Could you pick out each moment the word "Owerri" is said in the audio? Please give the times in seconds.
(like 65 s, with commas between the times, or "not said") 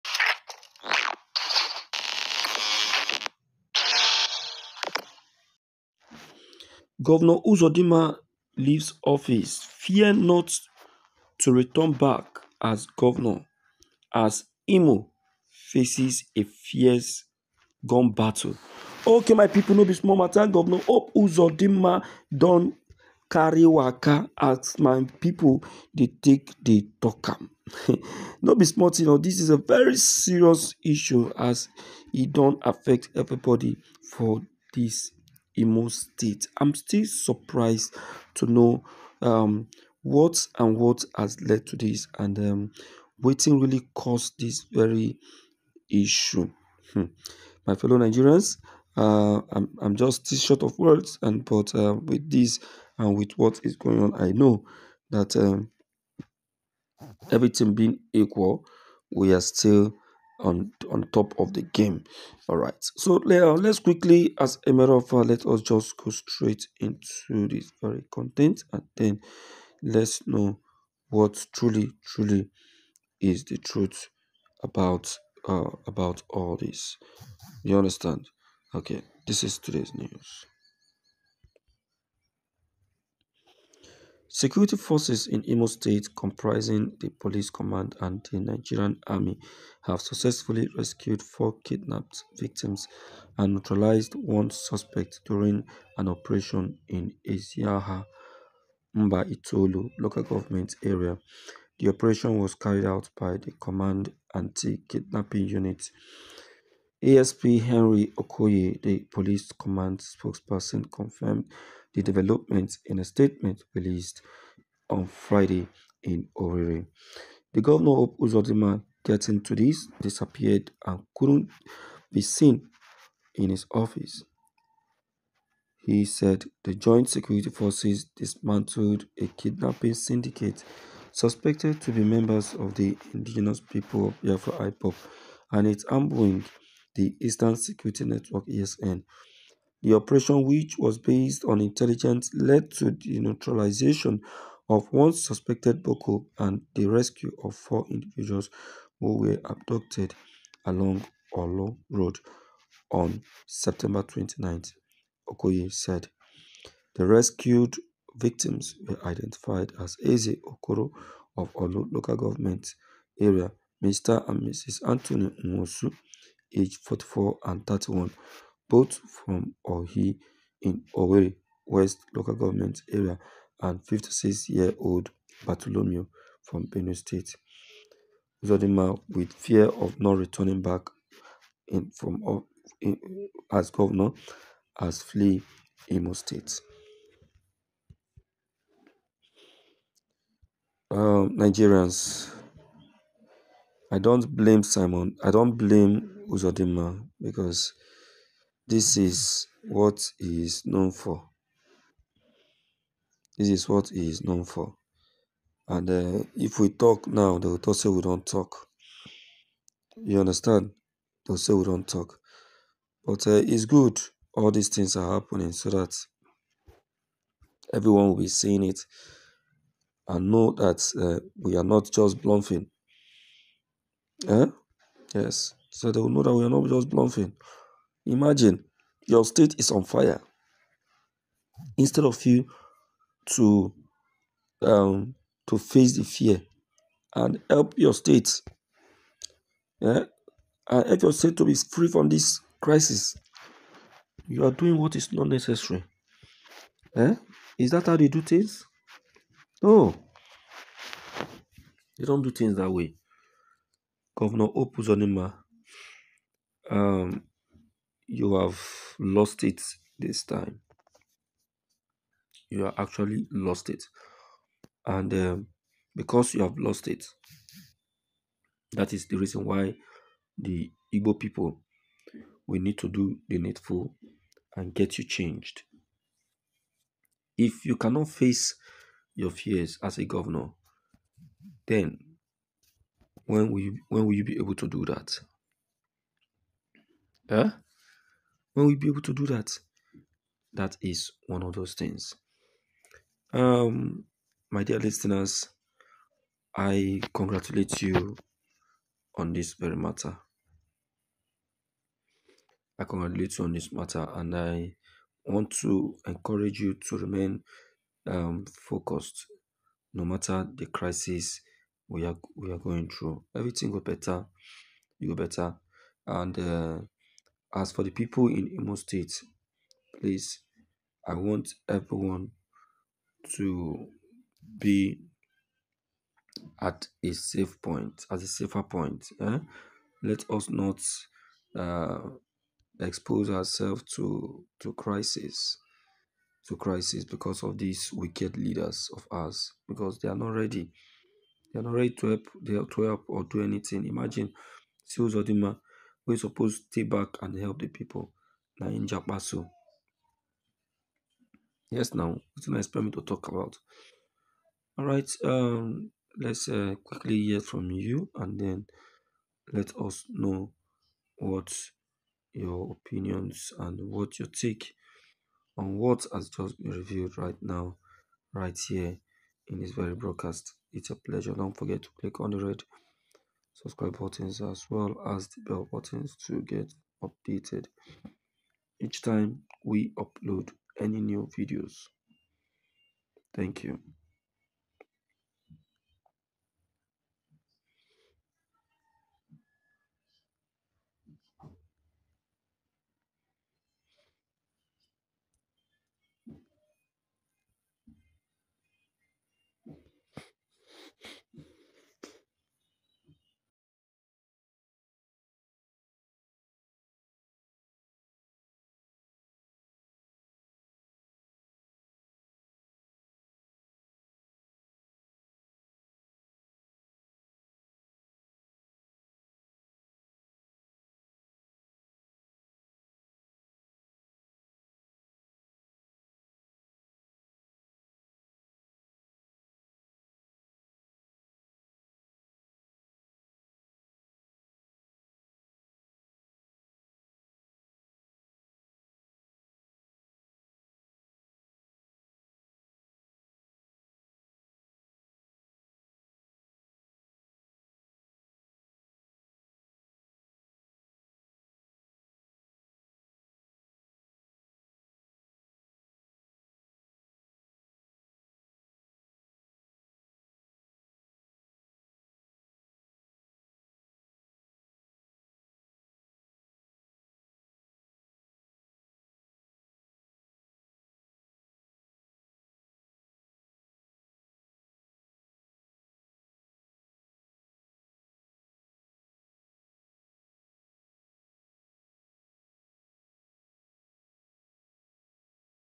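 116 s, 170 s.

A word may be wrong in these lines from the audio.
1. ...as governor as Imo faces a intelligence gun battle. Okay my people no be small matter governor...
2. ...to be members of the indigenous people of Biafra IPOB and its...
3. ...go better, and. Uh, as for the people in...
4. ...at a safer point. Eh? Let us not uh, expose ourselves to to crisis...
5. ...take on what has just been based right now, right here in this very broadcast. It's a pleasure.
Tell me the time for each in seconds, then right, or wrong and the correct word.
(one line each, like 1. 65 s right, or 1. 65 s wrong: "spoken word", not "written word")
1. 12 s wrong: "fierce", not "intelligence"
2. 131 s right
3. 315 s right
4. 328 s right
5. 364 s wrong: "reviewed", not "based".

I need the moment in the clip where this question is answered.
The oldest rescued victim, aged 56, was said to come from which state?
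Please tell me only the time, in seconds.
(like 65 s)
176 s.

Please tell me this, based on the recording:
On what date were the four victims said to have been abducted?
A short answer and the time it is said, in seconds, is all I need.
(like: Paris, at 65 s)
September 29, at 153 s.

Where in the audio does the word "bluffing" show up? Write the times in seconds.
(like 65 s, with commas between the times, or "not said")
222 s, 226 s.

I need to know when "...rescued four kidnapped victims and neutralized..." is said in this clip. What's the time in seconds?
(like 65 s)
90 s.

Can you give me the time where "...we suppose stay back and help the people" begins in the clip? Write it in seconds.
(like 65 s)
346 s.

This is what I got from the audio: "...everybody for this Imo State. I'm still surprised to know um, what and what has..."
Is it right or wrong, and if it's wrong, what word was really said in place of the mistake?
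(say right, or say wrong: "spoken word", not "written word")
right.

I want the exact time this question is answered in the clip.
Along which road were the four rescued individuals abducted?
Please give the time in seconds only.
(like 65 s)
151 s.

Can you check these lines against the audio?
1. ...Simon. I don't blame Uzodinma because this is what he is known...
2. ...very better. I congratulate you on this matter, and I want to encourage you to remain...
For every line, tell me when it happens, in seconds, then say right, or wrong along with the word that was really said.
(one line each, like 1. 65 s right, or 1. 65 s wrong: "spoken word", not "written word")
1. 194 s right
2. 299 s wrong: "matter", not "better".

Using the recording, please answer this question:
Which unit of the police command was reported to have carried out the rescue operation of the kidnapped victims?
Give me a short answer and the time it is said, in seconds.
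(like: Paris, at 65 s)
Command Anti-Kidnapping Unit, at 103 s.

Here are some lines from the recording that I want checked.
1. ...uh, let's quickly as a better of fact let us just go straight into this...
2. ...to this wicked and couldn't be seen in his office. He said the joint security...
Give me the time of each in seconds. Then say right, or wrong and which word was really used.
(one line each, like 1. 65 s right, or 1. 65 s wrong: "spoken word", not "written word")
1. 63 s wrong: "matter", not "better"
2. 119 s wrong: "disappeared", not "wicked".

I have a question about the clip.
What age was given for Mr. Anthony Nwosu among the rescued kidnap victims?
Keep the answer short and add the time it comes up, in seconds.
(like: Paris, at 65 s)
44, at 166 s.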